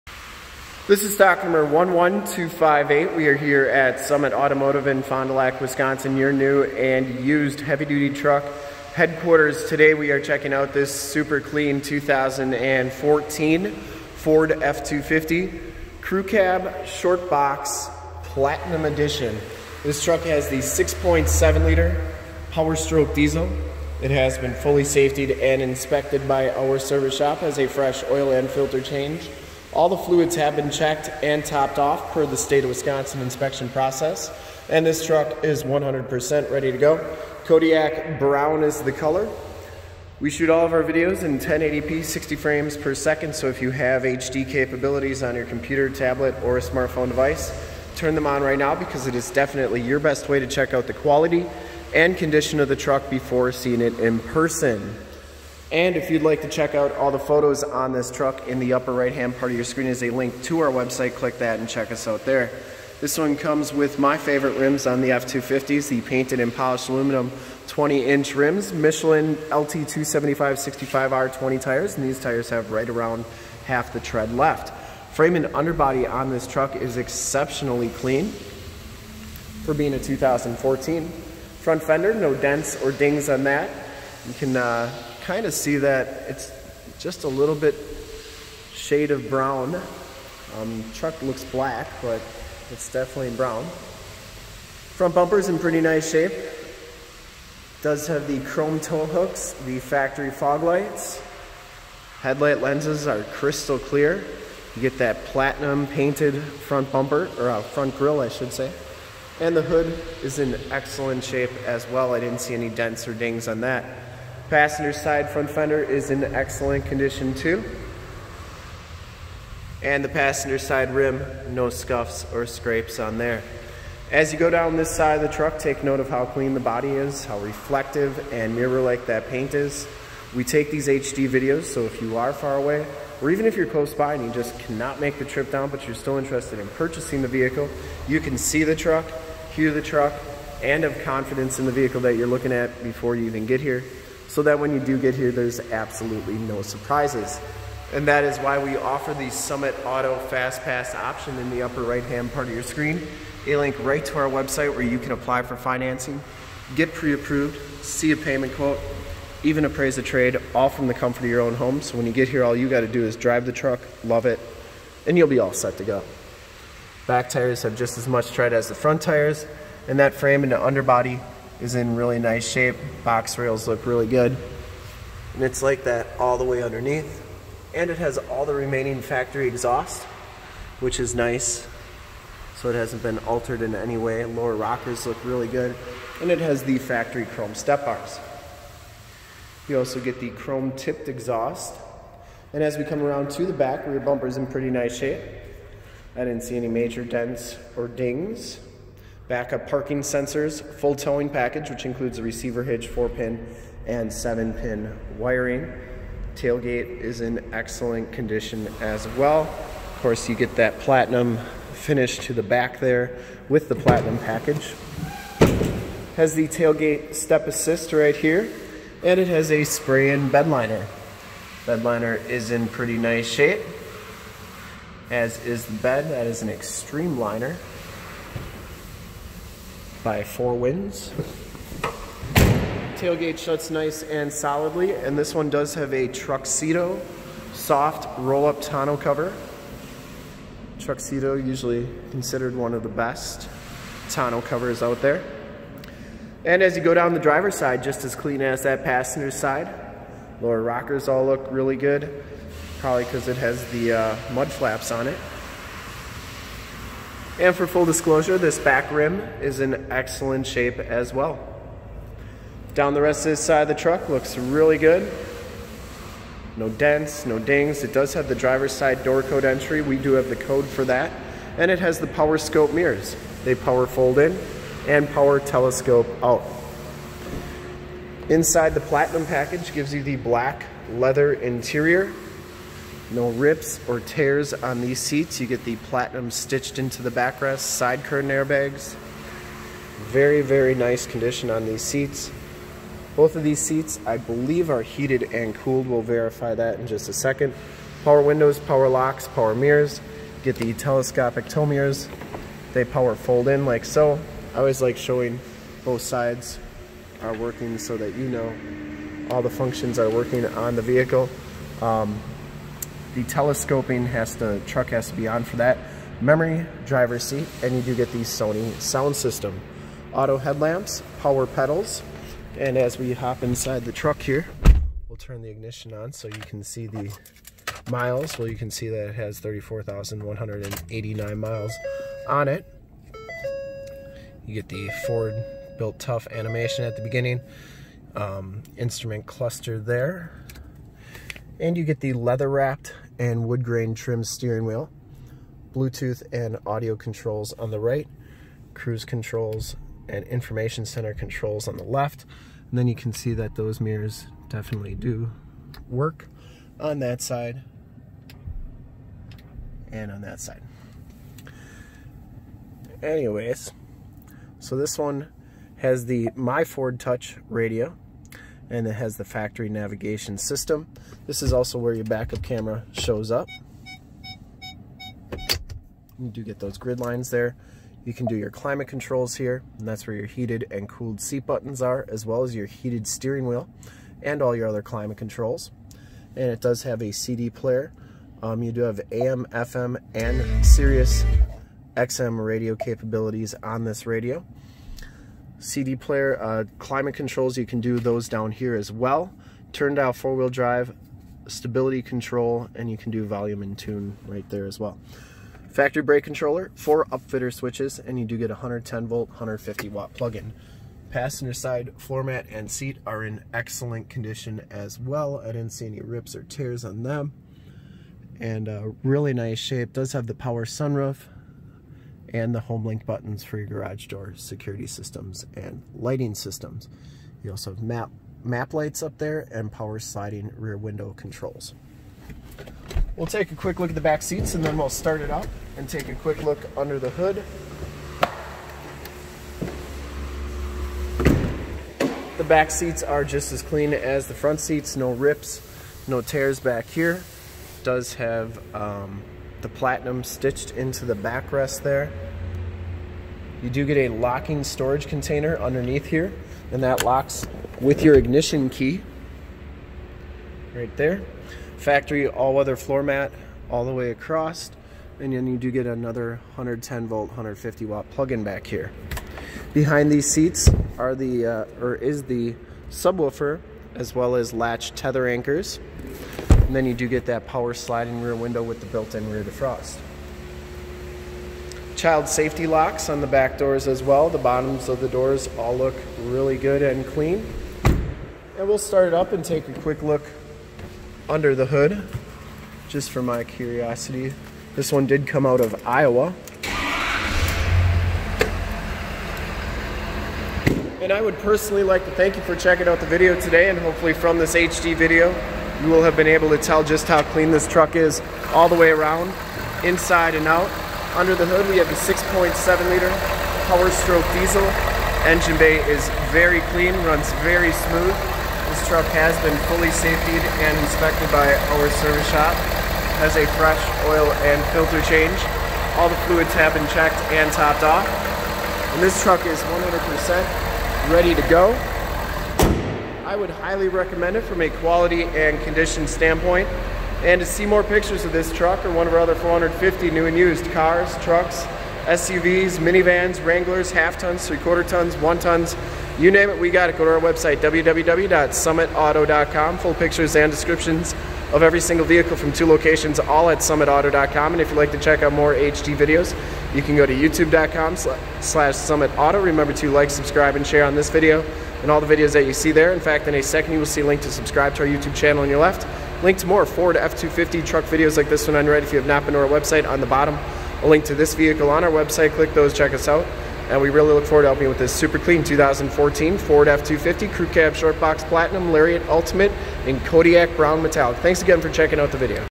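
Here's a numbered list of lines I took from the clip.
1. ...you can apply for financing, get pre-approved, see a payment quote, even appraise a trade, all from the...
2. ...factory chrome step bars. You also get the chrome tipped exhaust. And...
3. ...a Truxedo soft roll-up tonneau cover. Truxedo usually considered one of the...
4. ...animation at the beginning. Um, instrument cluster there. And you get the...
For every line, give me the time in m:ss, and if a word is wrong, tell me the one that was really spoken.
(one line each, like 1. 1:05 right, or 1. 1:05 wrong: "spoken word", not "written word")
1. 2:34 right
2. 3:06 right
3. 3:55 right
4. 5:36 right.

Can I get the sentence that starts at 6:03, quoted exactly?
Anyways, so this one has the My Ford Touch radio, and it has the factory navigation system.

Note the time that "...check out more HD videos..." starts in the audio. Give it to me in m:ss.
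9:14.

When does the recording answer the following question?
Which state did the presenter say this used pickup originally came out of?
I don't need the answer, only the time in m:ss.
8:15.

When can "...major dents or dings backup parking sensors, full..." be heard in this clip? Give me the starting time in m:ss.
3:16.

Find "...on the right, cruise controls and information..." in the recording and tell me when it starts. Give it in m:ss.
5:47.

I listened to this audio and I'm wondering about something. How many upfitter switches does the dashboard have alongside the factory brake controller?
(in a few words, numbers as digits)
4.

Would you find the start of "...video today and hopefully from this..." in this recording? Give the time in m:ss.
8:23.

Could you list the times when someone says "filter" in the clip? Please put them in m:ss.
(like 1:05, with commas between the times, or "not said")
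0:28, 8:44.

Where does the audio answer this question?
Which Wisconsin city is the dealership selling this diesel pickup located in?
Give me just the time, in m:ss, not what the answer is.
0:05.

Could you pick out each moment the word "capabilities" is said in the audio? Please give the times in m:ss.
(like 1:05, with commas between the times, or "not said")
0:44, 6:32.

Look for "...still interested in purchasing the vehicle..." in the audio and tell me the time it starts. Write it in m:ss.
2:15.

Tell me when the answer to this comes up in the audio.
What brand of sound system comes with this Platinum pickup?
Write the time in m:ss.
5:18.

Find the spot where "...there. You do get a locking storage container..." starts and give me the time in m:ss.
7:31.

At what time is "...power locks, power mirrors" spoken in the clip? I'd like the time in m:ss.
4:58.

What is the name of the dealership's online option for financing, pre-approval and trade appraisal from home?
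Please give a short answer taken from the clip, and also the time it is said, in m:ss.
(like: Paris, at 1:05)
Summit Auto Fast Pass, at 2:29.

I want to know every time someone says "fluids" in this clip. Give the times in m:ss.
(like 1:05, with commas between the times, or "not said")
0:29, 8:46.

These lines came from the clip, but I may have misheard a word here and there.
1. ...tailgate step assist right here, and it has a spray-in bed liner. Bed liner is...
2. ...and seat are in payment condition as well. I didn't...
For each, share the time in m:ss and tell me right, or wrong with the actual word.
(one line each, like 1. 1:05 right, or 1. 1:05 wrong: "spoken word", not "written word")
1. 3:36 right
2. 6:52 wrong: "excellent", not "payment".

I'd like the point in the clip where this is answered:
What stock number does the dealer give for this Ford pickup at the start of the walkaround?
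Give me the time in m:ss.
0:01.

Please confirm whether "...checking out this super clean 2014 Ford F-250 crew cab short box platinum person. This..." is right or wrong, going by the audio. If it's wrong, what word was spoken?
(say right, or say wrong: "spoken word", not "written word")
wrong: "edition", not "person".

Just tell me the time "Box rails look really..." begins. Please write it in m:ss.
2:53.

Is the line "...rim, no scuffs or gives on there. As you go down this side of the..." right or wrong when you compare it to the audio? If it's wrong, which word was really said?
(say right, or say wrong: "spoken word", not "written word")
wrong: "scrapes", not "gives".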